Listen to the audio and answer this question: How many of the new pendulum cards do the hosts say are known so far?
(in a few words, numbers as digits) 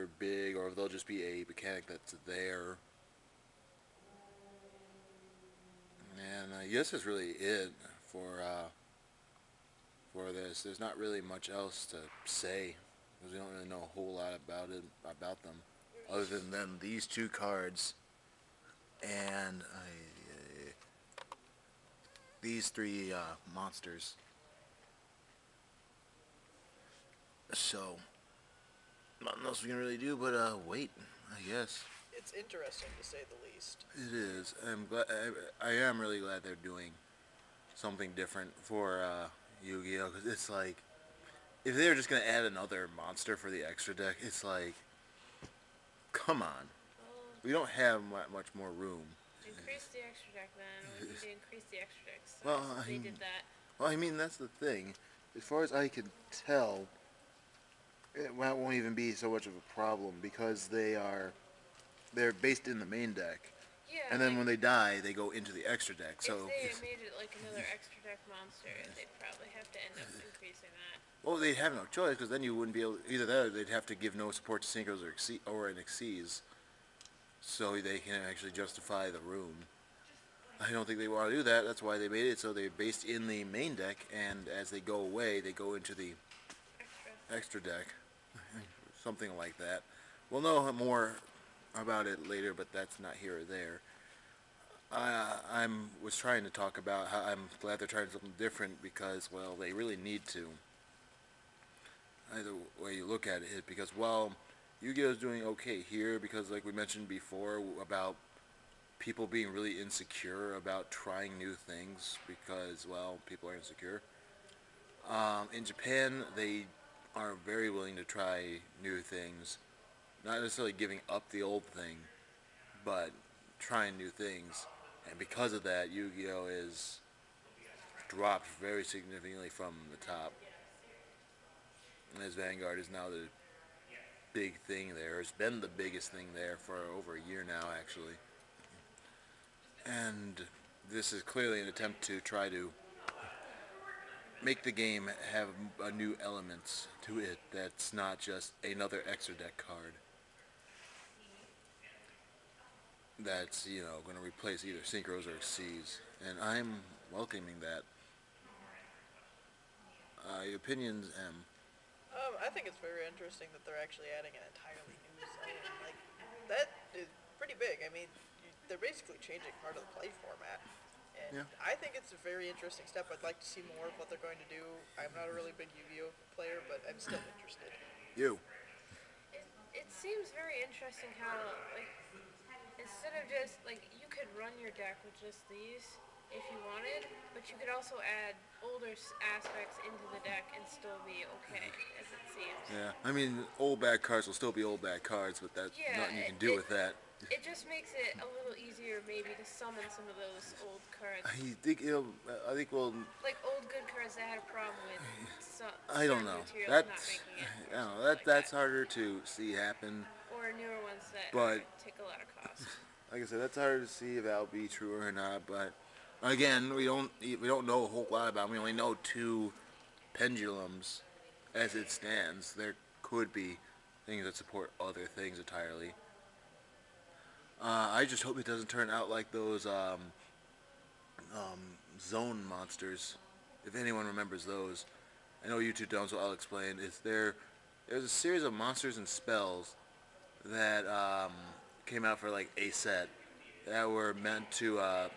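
2.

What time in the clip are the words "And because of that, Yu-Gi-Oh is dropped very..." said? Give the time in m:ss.
2:05.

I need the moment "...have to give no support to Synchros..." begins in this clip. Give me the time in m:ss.
1:13.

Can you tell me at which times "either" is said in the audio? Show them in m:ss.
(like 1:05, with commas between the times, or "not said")
1:13, 1:42, 2:34.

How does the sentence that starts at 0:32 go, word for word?
It's interesting to say the least.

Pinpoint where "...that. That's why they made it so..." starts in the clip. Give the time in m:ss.
1:21.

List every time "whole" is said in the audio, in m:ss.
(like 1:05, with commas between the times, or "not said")
0:13, 3:37.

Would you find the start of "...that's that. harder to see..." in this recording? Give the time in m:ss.
3:28.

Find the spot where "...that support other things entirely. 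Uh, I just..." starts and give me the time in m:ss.
3:44.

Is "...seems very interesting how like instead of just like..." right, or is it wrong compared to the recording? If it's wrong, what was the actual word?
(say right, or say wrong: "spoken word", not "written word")
right.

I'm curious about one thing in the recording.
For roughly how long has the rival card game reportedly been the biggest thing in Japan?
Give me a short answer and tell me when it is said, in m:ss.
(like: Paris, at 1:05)
over a year, at 2:16.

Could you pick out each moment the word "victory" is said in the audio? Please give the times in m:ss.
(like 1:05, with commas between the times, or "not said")
not said.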